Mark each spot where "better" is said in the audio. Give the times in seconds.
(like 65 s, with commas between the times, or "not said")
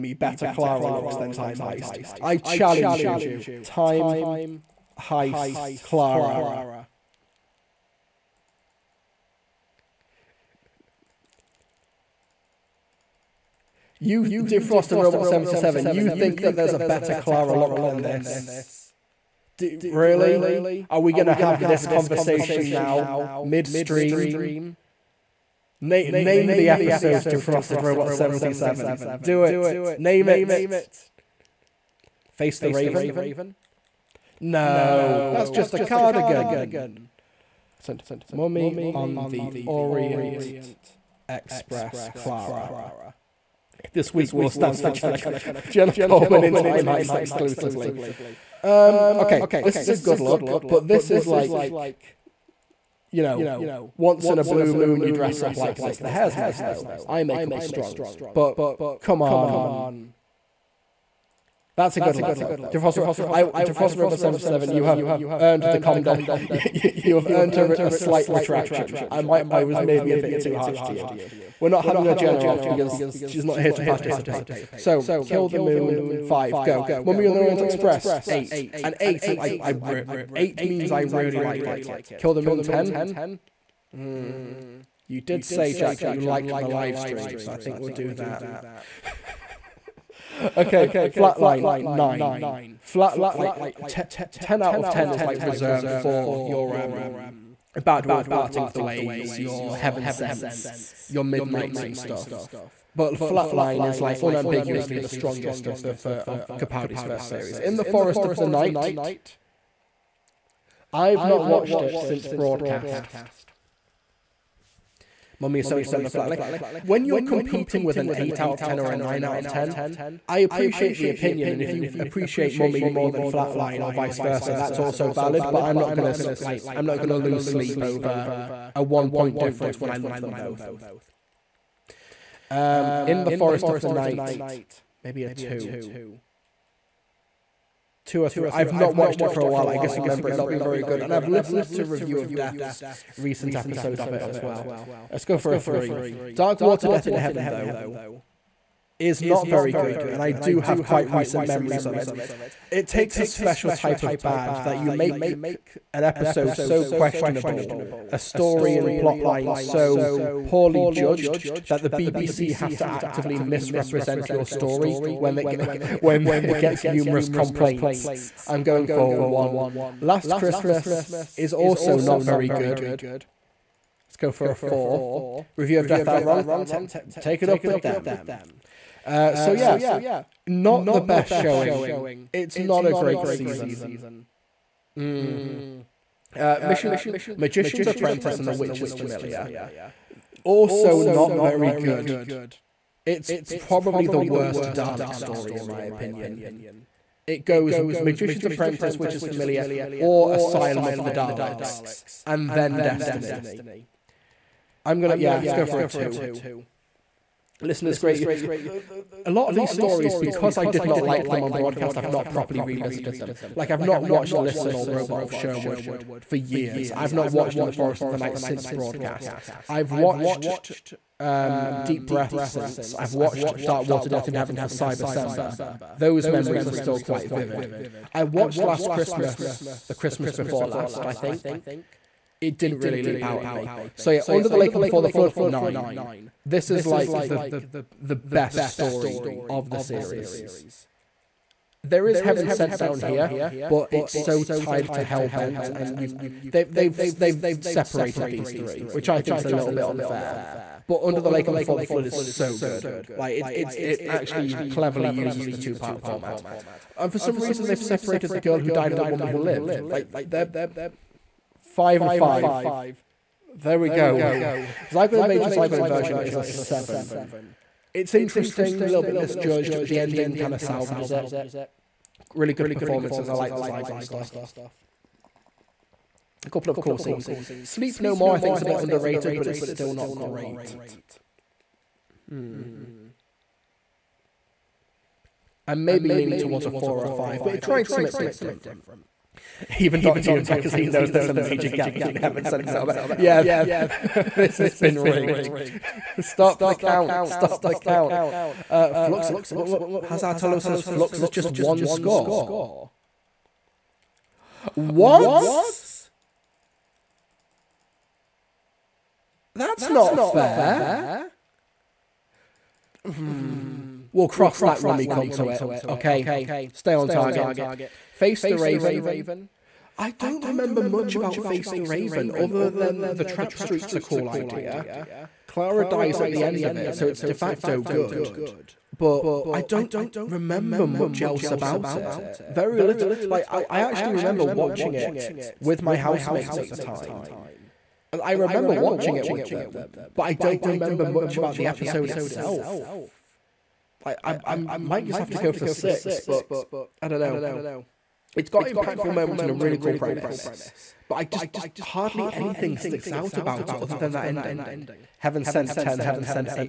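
0 s, 16 s, 115 s.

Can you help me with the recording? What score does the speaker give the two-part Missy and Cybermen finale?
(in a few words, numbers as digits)
1.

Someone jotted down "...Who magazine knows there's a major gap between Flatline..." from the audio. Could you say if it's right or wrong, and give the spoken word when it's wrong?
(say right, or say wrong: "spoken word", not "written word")
wrong: "Heaven", not "Flatline".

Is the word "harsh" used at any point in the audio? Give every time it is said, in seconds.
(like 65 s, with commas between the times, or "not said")
70 s.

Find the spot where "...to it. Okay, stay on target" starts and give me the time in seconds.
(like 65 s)
315 s.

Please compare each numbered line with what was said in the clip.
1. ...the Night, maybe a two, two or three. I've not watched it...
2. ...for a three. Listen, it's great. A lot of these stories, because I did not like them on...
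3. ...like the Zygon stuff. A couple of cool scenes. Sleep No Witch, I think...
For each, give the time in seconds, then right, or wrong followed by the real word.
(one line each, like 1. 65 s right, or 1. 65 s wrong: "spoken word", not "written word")
1. 133 s right
2. 205 s wrong: "two", not "three"
3. 273 s wrong: "More", not "Witch".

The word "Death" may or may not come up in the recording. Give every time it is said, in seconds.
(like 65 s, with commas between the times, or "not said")
142 s, 146 s, 175 s, 224 s.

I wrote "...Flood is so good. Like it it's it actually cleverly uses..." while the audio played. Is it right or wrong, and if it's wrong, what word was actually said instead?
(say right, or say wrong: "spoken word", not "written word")
right.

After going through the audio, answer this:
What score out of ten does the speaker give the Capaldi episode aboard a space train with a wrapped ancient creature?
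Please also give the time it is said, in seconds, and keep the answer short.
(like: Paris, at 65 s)
8, at 77 s.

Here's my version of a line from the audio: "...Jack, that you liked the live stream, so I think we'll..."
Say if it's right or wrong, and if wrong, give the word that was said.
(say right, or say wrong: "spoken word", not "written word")
right.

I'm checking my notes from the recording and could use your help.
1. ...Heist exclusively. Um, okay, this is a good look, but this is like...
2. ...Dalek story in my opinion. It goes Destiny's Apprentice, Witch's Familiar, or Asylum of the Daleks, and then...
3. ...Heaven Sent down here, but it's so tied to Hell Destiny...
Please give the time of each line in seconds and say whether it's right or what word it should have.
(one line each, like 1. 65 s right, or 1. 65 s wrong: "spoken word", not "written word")
1. 46 s right
2. 194 s wrong: "Magician", not "Destiny"
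3. 242 s wrong: "Bent", not "Destiny".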